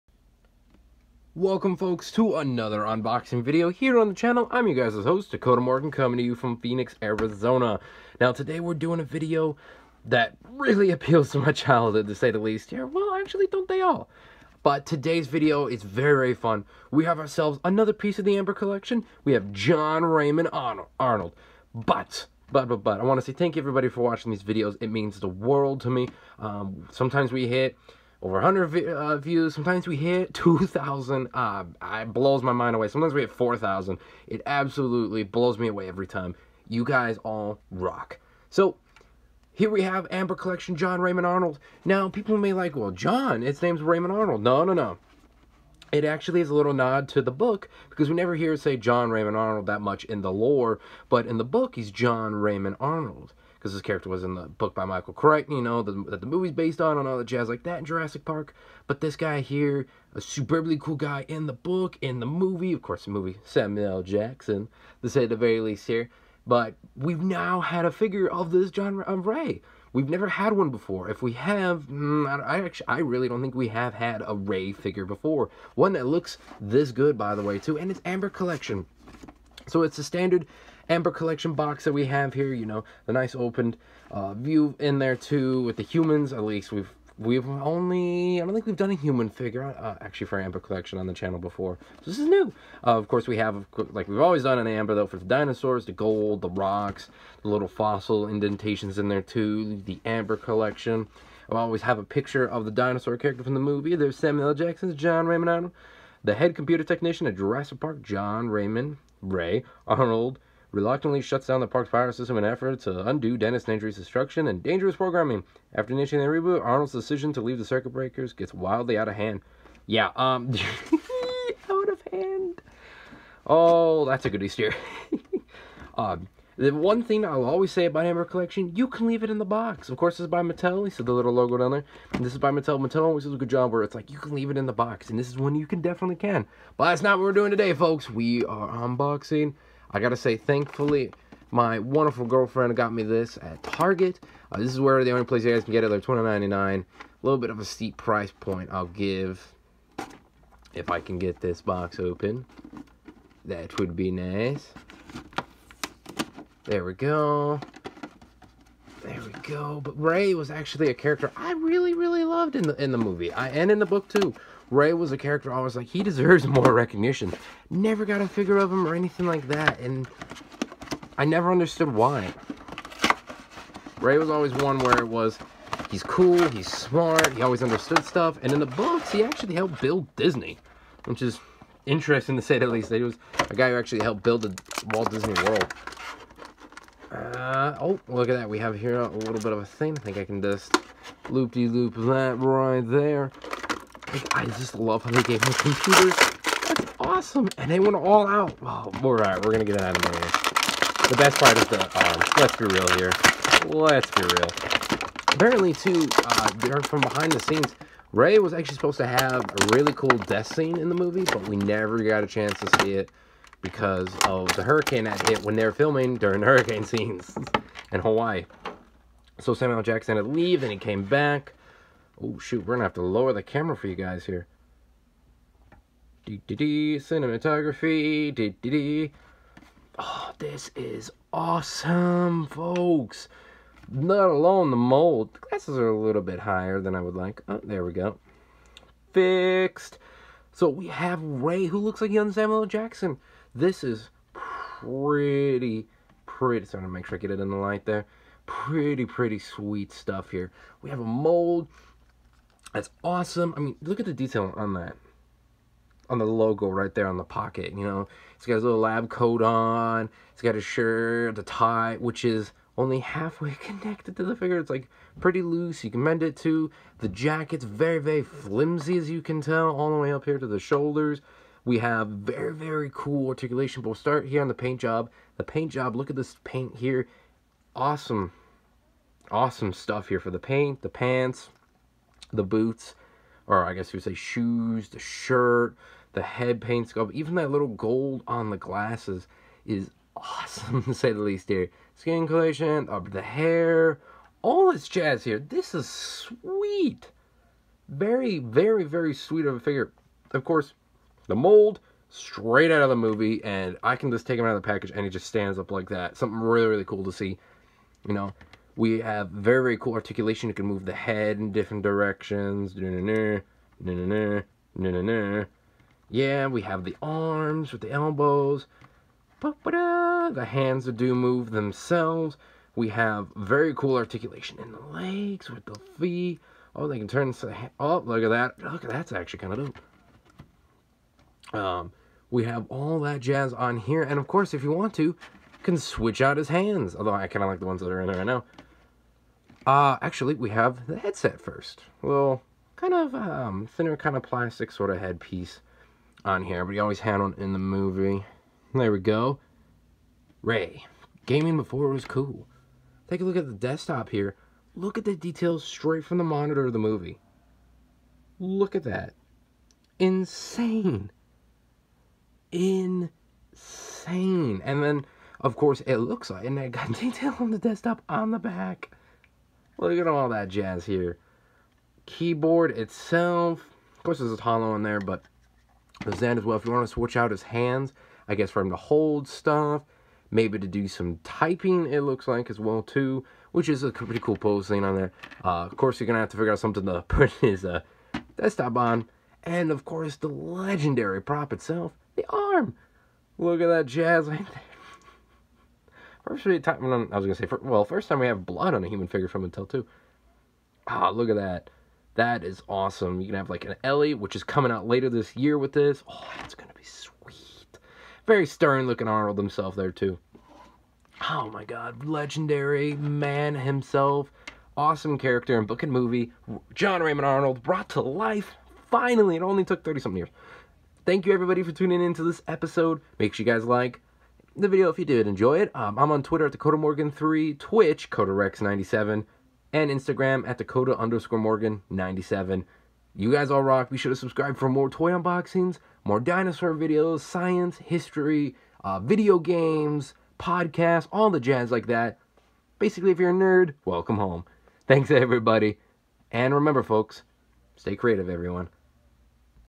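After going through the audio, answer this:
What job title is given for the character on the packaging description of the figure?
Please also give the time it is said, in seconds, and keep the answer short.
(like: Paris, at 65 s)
head computer technician, at 106 s.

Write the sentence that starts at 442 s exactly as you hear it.
Basically, if you're a nerd, welcome home.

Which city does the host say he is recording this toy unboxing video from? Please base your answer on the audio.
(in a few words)
Phoenix, Arizona.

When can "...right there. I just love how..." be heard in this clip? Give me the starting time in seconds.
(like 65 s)
192 s.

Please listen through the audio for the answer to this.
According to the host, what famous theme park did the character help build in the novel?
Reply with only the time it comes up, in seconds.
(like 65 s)
184 s.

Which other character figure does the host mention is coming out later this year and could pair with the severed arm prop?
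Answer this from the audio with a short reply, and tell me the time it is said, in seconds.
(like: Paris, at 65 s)
Ellie, at 403 s.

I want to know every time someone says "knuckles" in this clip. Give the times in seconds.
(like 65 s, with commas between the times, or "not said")
not said.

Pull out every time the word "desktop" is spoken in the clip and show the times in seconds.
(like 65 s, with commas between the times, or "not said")
353 s, 367 s, 388 s.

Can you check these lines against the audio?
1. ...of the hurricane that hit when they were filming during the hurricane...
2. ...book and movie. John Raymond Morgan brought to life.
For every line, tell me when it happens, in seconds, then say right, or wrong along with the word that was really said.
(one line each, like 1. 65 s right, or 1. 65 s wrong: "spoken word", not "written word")
1. 214 s right
2. 415 s wrong: "Arnold", not "Morgan".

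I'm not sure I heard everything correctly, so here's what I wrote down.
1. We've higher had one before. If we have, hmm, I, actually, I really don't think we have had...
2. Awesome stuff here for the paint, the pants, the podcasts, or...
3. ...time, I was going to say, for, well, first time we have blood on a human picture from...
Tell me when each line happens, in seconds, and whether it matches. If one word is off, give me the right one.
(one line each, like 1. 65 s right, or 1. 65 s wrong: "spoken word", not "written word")
1. 69 s wrong: "never", not "higher"
2. 279 s wrong: "boots", not "podcasts"
3. 396 s wrong: "figure", not "picture".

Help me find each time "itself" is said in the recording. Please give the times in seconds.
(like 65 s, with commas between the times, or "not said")
372 s, 391 s.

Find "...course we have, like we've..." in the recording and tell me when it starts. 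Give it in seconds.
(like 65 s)
93 s.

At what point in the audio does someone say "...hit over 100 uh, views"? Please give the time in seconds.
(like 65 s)
27 s.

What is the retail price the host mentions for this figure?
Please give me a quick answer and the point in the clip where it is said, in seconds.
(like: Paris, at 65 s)
$29.99, at 145 s.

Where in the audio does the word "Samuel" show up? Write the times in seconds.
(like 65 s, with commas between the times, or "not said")
63 s, 104 s, 219 s, 242 s.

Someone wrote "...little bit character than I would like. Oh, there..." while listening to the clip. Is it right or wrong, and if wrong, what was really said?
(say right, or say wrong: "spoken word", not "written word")
wrong: "higher", not "character".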